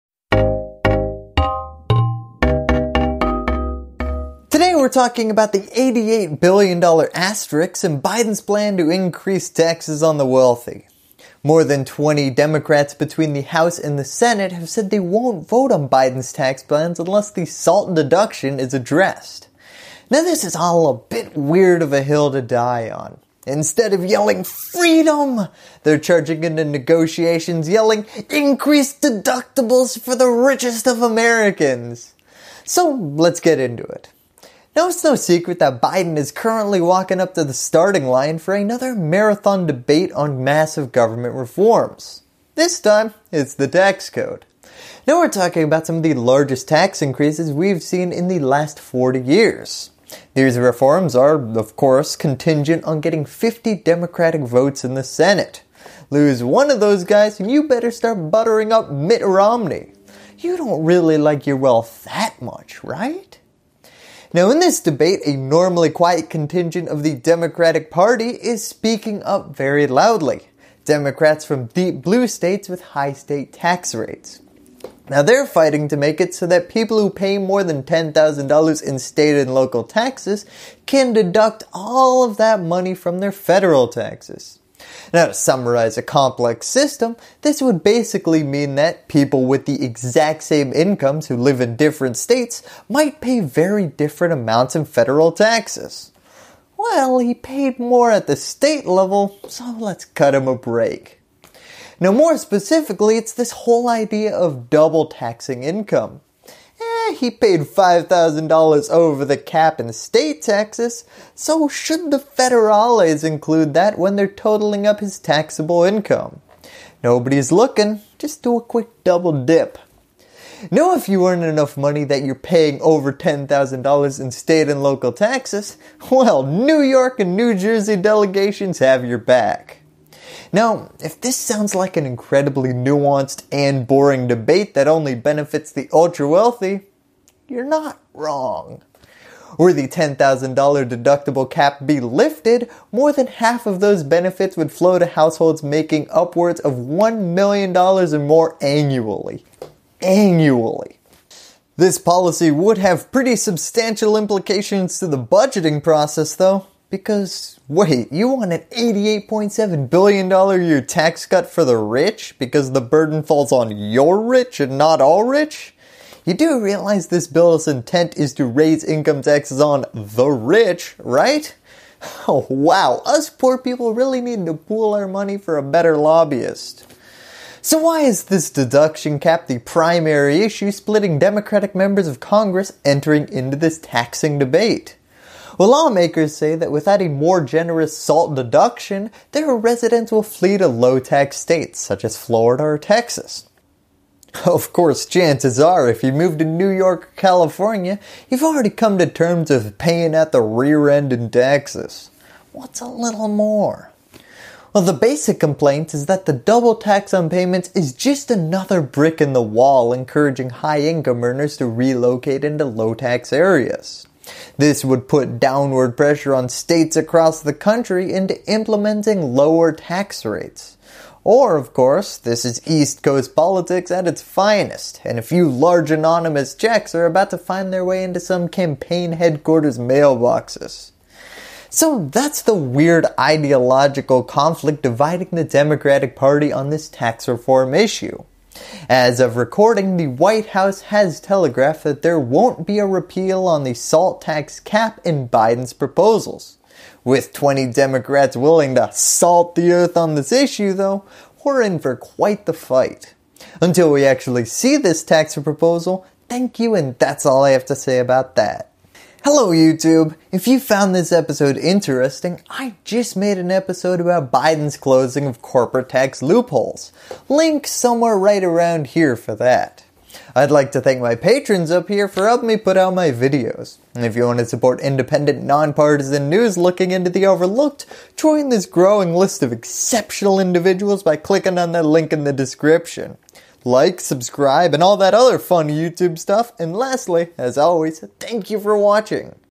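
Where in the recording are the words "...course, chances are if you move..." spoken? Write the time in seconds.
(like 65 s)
194 s.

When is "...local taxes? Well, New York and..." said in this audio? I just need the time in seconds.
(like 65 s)
124 s.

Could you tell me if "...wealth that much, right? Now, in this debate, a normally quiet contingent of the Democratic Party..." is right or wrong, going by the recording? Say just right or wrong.
right.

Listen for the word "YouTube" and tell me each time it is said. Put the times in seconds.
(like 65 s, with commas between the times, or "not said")
259 s, 285 s.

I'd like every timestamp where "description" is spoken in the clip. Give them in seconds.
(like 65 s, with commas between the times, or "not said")
282 s.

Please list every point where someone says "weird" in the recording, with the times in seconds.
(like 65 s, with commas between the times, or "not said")
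21 s, 232 s.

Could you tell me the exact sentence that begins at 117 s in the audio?
Nobody's looking, just do a quick double dip.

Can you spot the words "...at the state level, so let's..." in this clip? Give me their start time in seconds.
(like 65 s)
98 s.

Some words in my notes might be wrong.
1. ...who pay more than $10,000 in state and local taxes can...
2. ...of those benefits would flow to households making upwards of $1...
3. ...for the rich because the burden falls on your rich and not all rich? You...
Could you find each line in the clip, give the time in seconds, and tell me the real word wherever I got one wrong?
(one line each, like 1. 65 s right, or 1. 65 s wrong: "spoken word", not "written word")
1. 76 s right
2. 143 s right
3. 161 s right.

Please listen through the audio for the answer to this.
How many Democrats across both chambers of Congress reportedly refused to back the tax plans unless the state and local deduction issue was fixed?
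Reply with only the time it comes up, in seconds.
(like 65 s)
11 s.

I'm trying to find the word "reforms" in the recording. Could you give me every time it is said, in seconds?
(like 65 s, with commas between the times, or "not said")
41 s, 50 s, 237 s.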